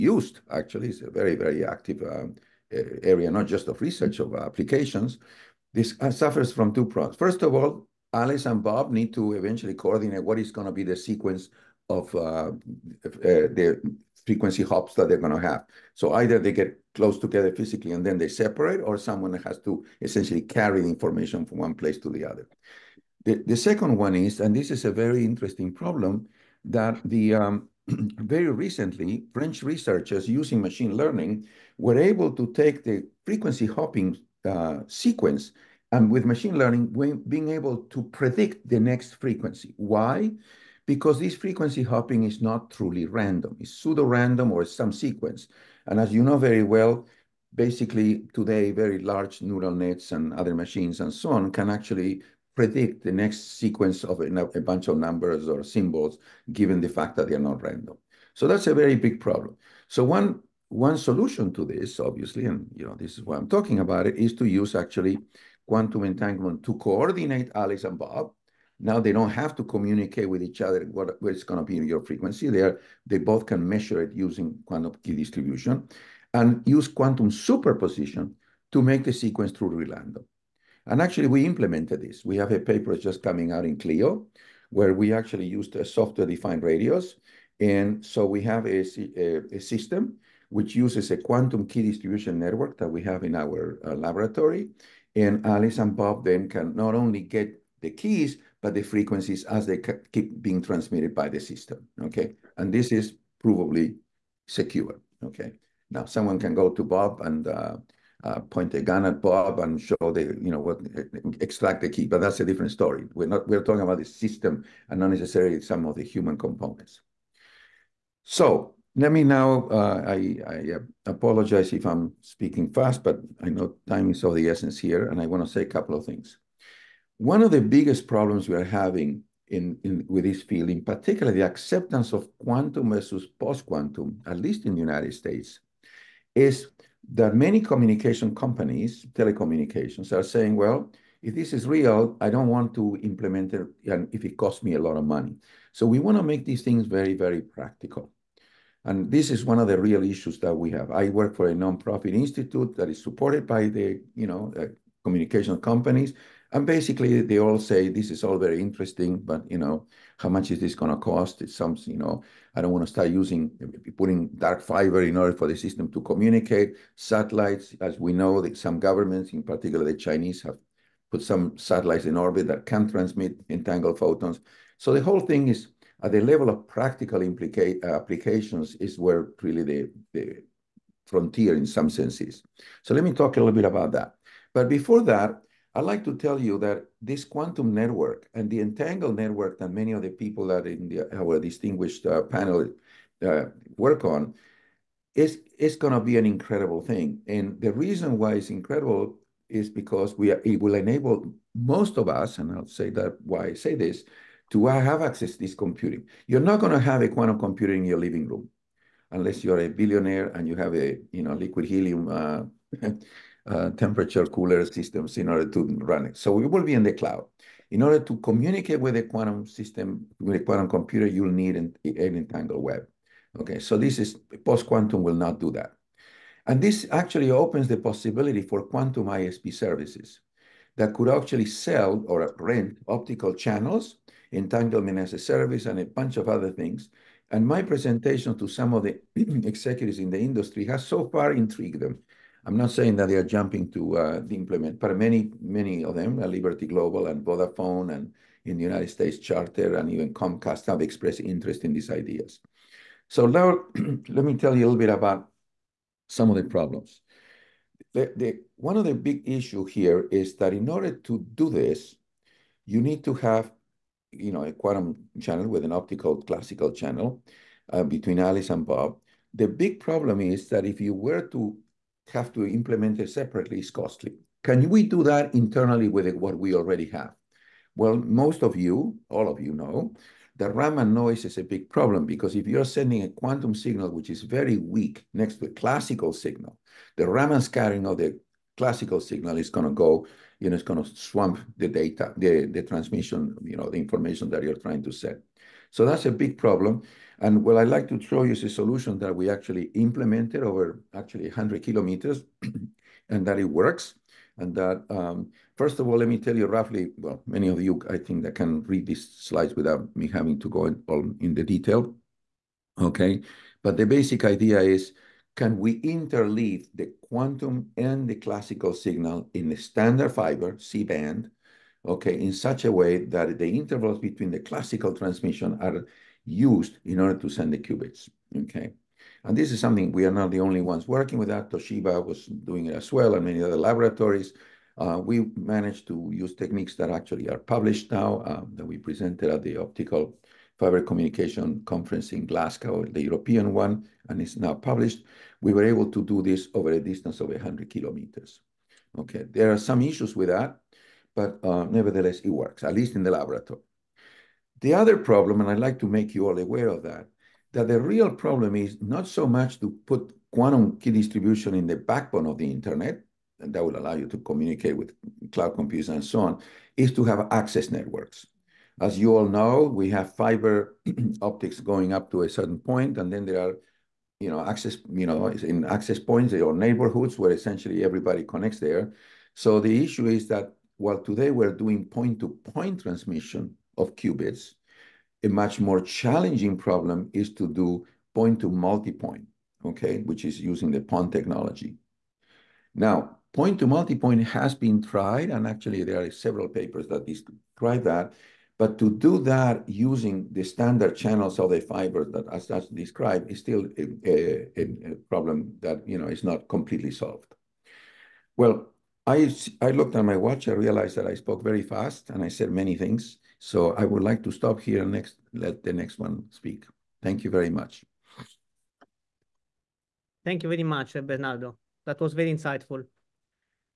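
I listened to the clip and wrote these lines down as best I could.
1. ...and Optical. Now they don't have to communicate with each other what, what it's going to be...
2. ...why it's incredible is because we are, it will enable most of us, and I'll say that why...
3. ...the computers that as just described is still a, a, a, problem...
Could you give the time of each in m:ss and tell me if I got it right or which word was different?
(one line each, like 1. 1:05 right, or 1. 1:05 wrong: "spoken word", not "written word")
1. 1:07 wrong: "Bob", not "Optical"
2. 3:18 right
3. 6:41 wrong: "fibers", not "computers".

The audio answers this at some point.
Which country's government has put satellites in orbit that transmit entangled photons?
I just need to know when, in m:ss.
2:49.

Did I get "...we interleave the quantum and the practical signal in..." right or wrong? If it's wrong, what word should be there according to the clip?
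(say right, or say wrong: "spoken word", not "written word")
wrong: "classical", not "practical".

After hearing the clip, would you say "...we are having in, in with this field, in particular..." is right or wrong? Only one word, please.
right.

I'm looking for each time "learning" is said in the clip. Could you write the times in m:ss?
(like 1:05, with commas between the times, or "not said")
0:30, 0:36.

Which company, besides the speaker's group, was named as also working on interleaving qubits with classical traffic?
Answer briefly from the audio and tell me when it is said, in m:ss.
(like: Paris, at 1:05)
Toshiba, at 5:31.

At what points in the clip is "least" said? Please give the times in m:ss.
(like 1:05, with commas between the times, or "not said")
2:14, 5:52.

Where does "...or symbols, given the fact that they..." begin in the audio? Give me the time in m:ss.
0:55.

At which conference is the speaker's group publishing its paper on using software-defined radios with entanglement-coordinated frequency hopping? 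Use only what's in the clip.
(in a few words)
CLEO.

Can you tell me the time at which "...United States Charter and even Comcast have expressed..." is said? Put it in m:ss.
4:08.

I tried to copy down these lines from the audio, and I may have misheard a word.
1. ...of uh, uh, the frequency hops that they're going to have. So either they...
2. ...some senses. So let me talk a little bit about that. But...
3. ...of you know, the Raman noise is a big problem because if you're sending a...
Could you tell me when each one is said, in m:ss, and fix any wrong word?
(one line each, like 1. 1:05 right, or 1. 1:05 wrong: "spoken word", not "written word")
1. 0:11 right
2. 3:01 right
3. 4:39 right.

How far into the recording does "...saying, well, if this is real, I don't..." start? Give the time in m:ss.
2:20.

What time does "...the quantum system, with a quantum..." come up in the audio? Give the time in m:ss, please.
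3:38.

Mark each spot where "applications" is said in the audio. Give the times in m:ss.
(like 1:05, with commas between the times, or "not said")
0:04, 2:57.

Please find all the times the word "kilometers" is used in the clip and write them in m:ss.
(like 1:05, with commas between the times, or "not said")
5:01, 5:47.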